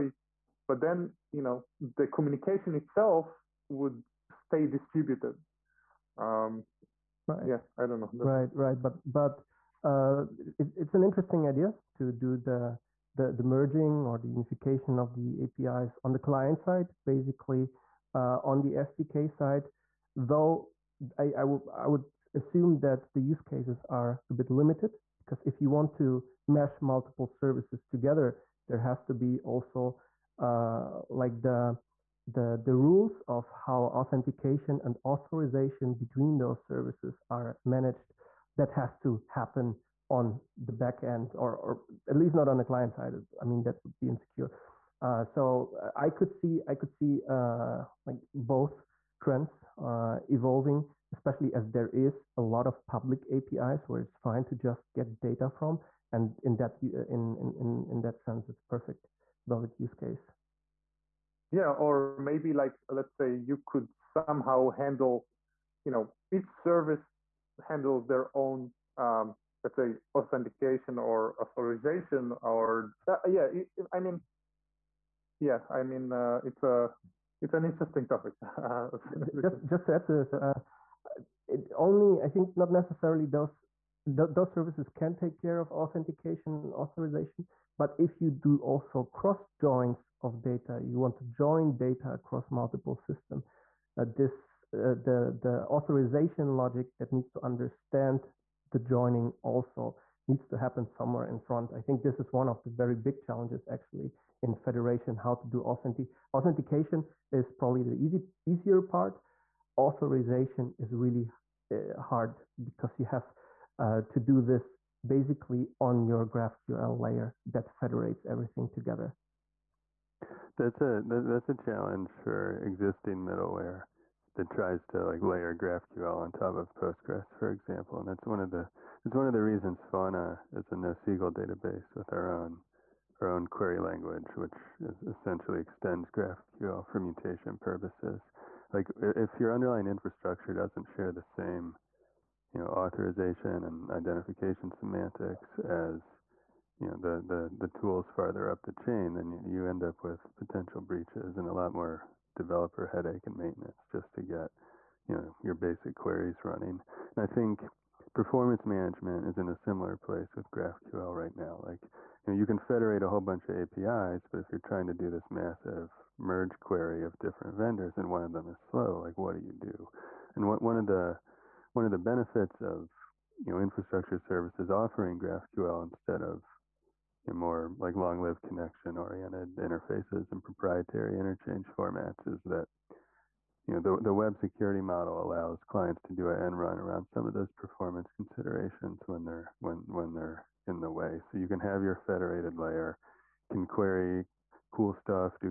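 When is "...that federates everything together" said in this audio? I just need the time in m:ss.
1:57.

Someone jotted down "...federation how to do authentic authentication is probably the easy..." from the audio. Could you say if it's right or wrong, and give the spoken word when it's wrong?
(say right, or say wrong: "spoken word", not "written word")
right.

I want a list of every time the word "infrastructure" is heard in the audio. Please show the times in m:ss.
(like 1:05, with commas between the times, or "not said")
2:19, 2:53.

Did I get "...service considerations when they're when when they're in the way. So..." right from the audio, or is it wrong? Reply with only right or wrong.
wrong.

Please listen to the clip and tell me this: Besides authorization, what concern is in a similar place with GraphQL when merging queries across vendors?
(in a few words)
performance management.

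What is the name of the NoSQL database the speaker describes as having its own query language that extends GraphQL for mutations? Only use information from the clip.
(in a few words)
Fauna.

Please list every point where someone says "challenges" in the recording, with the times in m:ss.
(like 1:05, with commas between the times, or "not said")
1:43, 2:01.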